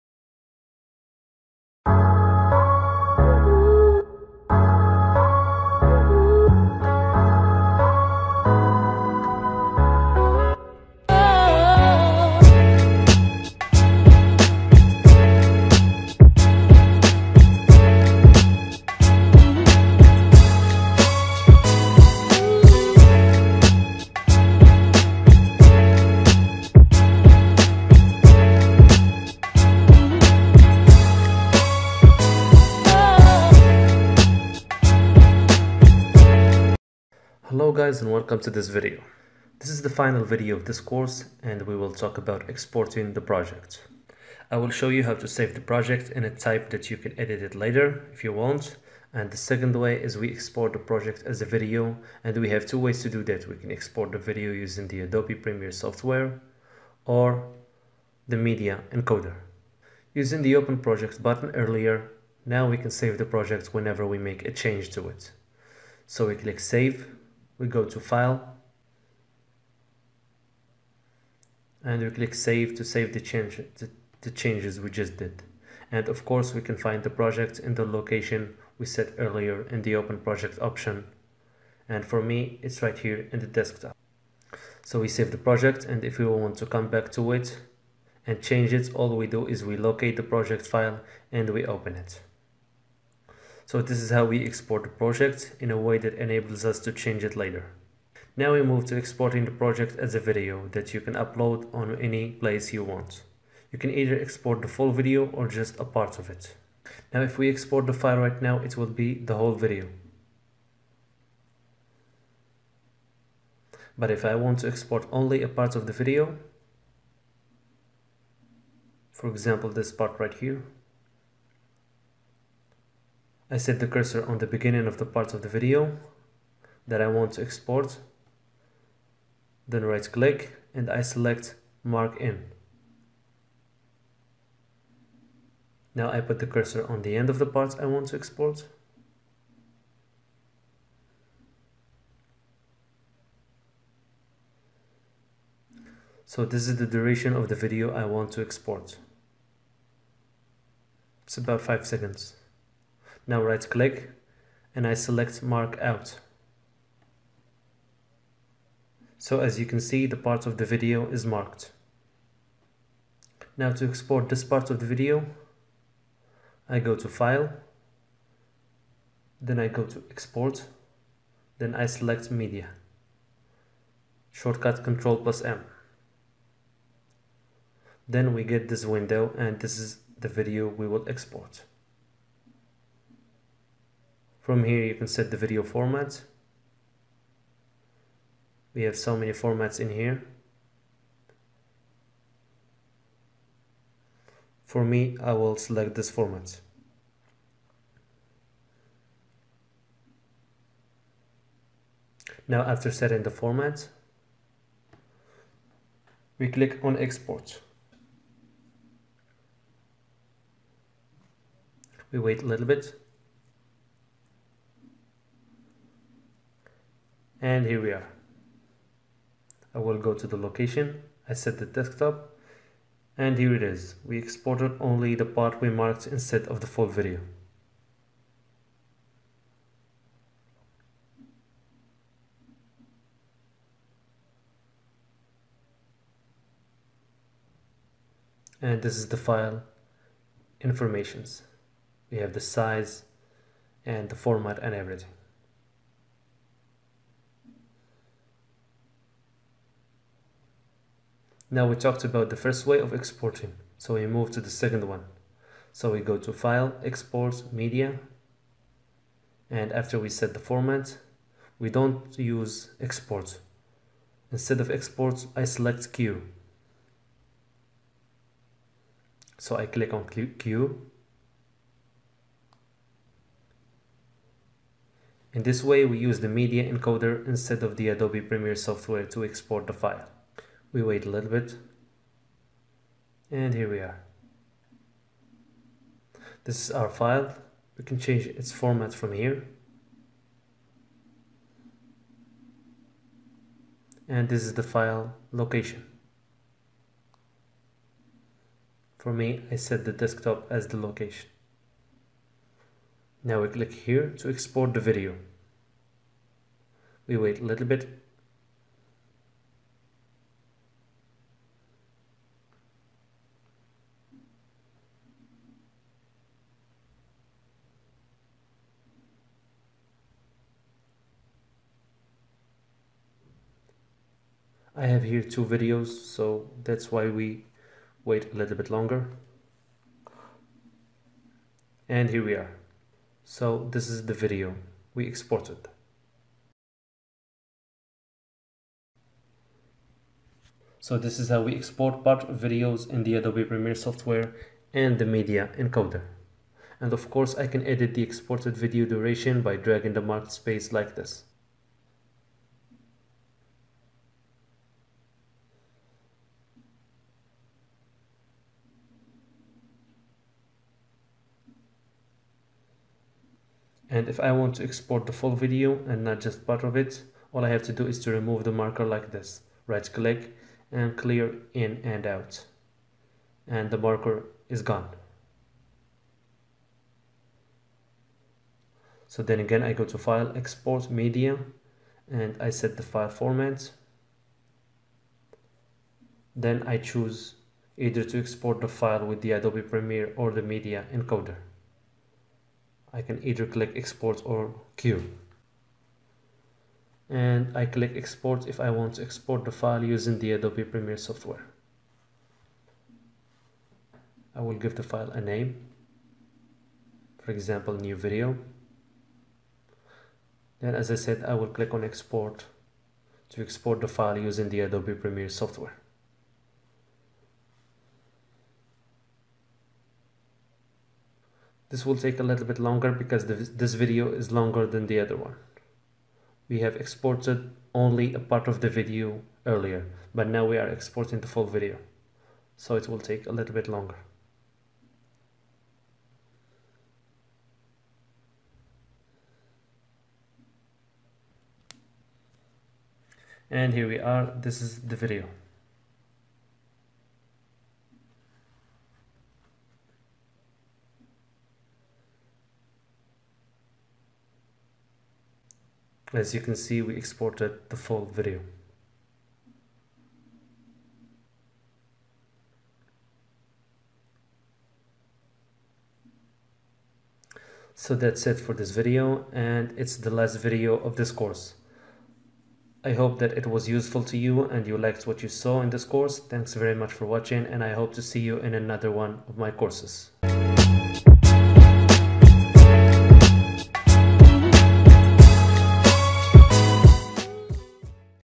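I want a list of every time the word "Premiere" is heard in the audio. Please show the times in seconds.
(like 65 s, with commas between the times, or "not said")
55 s, 278 s, 343 s, 389 s, 400 s, 414 s.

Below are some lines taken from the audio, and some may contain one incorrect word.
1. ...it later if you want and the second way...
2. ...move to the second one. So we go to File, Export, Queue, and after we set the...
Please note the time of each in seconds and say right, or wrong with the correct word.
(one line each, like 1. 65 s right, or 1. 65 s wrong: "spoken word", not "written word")
1. 47 s right
2. 254 s wrong: "Media", not "Queue".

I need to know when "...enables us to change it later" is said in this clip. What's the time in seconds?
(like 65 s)
96 s.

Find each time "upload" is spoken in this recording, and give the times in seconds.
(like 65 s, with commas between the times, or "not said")
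101 s.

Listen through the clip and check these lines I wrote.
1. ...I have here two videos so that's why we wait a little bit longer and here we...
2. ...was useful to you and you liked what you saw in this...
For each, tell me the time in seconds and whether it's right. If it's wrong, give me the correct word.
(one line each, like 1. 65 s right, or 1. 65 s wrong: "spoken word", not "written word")
1. 324 s right
2. 473 s right.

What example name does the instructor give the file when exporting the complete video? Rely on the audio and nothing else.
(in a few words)
New video.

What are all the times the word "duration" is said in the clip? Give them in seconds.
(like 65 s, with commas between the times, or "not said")
146 s, 348 s.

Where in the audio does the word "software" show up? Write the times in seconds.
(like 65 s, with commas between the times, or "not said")
55 s, 278 s, 343 s, 400 s, 415 s.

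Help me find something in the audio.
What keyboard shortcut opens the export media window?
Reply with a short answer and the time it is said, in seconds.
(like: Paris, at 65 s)
Control plus M, at 174 s.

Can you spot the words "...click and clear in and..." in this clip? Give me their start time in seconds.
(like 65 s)
369 s.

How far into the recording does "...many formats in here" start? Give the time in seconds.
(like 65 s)
189 s.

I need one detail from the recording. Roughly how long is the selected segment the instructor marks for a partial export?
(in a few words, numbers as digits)
5 seconds.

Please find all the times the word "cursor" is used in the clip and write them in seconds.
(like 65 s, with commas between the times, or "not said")
123 s, 136 s.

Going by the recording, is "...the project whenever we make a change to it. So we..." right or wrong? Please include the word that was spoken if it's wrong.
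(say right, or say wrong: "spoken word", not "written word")
right.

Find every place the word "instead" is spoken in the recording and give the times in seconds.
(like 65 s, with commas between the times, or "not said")
226 s, 264 s, 277 s.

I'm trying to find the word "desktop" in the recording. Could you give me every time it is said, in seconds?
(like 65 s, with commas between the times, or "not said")
83 s, 221 s, 299 s.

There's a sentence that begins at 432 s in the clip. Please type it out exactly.
So it will take a little bit longer.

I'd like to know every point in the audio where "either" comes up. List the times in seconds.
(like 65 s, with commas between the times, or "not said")
103 s, 387 s, 393 s.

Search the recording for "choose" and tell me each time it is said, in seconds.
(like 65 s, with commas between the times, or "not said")
386 s.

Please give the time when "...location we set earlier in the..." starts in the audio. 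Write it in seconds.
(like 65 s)
77 s.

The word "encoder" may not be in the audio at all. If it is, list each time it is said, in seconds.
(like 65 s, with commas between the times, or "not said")
58 s, 276 s, 345 s, 390 s.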